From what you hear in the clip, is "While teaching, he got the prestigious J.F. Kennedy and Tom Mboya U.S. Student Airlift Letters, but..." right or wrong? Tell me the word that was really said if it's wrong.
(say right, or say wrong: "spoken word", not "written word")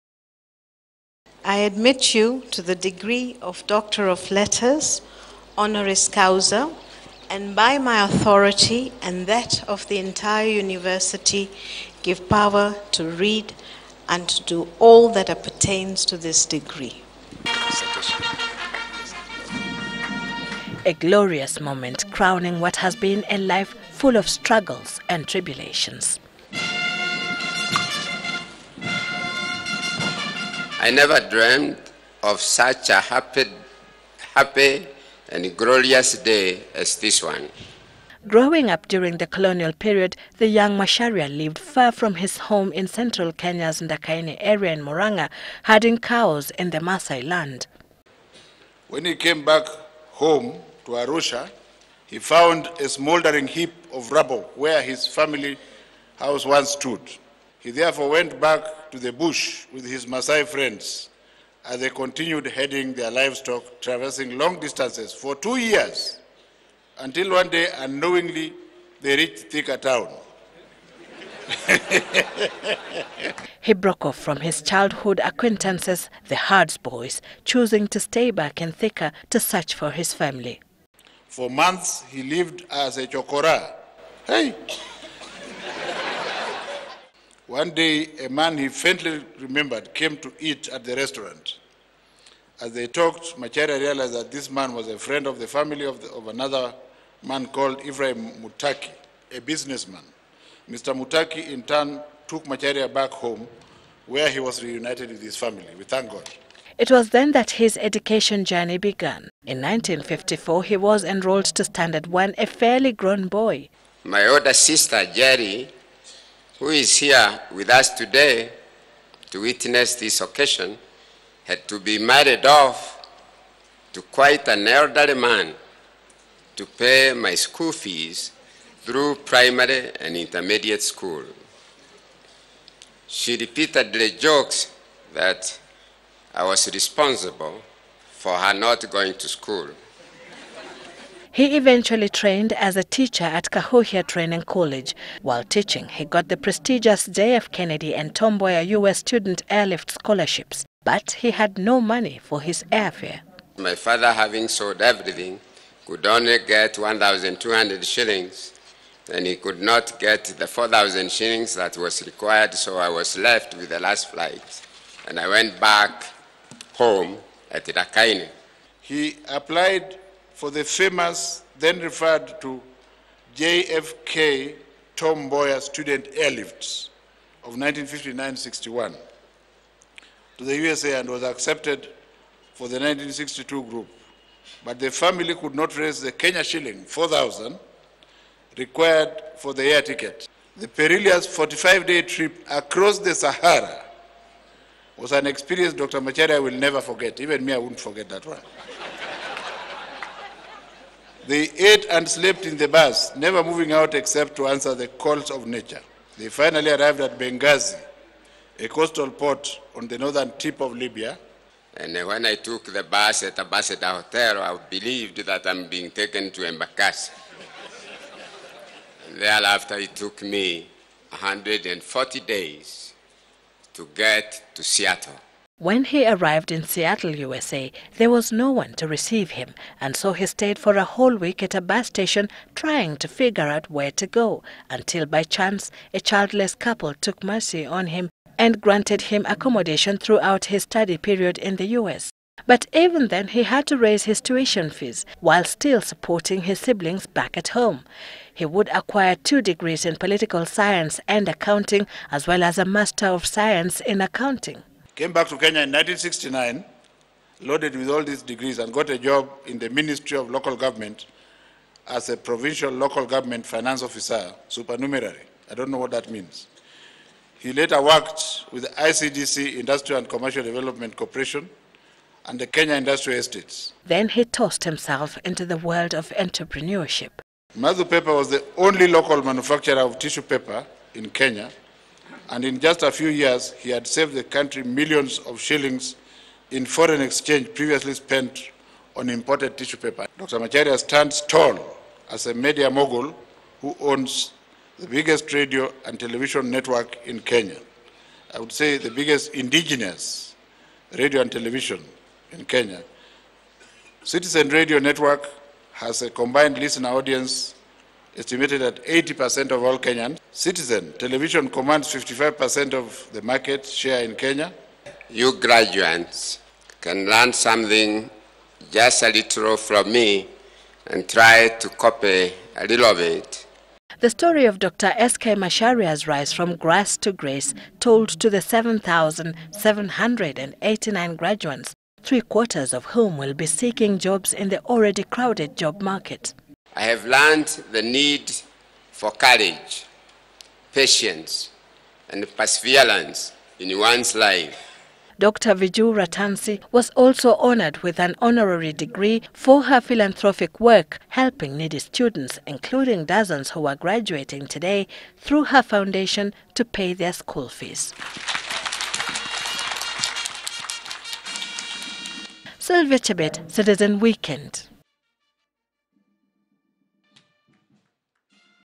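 wrong: "Scholarships", not "Letters".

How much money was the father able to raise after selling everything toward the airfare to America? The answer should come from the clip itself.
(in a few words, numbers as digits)
1,200 shillings.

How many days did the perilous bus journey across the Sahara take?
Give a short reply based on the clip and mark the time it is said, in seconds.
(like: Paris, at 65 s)
45, at 191 s.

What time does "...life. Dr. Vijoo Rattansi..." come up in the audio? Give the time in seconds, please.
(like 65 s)
344 s.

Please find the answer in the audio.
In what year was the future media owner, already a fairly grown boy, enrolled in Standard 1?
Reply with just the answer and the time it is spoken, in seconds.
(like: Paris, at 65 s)
1954, at 109 s.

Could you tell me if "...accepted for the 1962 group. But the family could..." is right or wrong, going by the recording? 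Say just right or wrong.
right.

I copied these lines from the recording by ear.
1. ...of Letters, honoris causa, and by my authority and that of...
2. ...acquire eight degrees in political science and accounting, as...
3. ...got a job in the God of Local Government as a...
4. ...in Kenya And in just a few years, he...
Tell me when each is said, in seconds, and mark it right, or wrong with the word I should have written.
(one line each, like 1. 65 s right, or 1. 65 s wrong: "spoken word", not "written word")
1. 4 s right
2. 248 s wrong: "two", not "eight"
3. 258 s wrong: "Ministry", not "God"
4. 280 s right.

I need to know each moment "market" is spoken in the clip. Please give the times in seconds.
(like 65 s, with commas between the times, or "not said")
313 s, 335 s.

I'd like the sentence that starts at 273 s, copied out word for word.
Then he tossed himself into the world of entrepreneurship.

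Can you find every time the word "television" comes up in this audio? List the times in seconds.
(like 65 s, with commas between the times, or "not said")
295 s, 301 s, 310 s.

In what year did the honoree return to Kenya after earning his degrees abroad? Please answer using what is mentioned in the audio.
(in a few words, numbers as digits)
1969.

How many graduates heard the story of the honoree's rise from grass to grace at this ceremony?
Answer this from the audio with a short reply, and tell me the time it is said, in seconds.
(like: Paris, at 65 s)
7,789, at 328 s.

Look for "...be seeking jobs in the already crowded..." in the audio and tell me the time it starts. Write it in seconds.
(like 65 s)
333 s.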